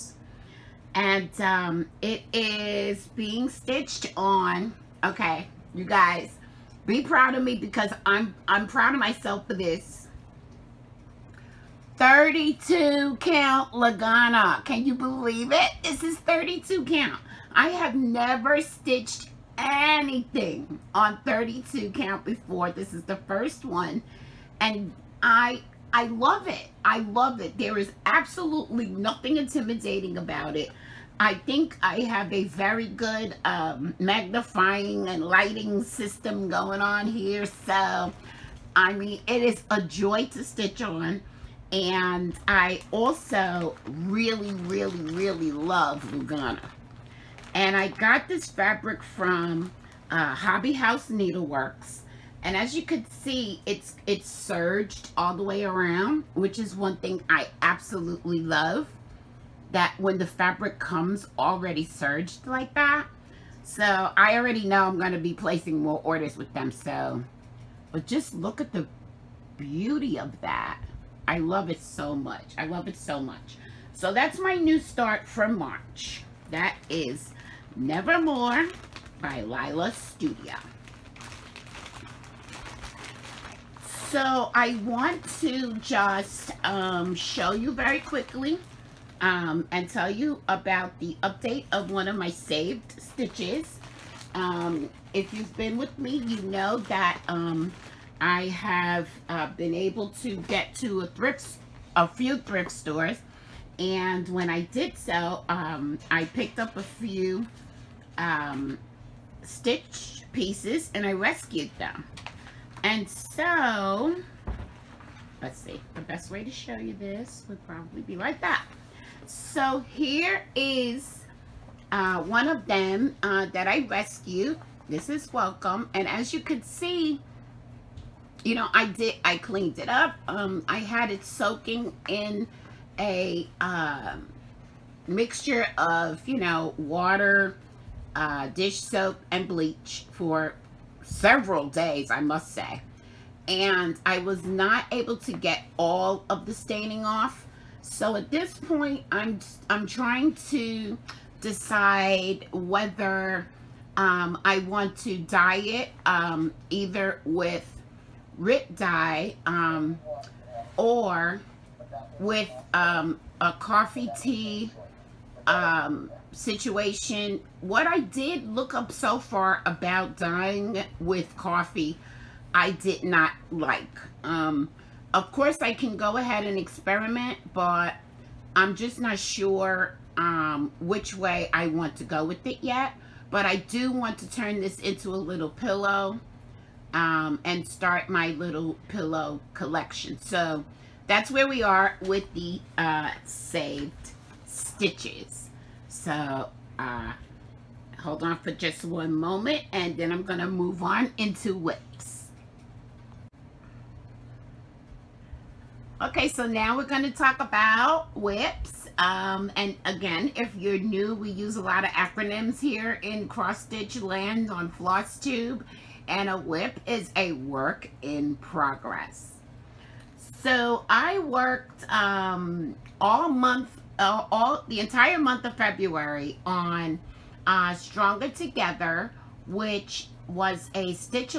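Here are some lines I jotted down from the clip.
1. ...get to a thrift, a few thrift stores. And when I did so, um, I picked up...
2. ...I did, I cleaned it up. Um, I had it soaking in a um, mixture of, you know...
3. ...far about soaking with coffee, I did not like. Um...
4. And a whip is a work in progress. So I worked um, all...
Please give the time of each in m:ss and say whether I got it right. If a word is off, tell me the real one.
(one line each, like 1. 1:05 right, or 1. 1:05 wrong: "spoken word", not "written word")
1. 1:40 right
2. 2:08 right
3. 2:49 wrong: "dying", not "soaking"
4. 3:36 right.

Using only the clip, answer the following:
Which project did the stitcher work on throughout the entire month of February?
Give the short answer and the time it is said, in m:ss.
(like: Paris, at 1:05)
Stronger Together, at 3:47.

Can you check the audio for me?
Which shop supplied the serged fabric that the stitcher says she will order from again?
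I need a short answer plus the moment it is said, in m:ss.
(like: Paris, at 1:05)
Hobby House Needleworks, at 0:50.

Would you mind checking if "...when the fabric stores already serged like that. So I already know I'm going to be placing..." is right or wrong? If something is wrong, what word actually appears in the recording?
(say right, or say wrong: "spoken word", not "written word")
wrong: "comes", not "stores".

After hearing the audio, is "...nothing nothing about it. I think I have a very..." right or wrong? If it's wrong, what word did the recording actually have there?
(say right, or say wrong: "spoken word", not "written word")
wrong: "intimidating", not "nothing".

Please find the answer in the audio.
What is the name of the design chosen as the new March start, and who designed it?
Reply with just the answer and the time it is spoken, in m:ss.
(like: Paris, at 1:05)
Nevermore by Lila Studio, at 1:17.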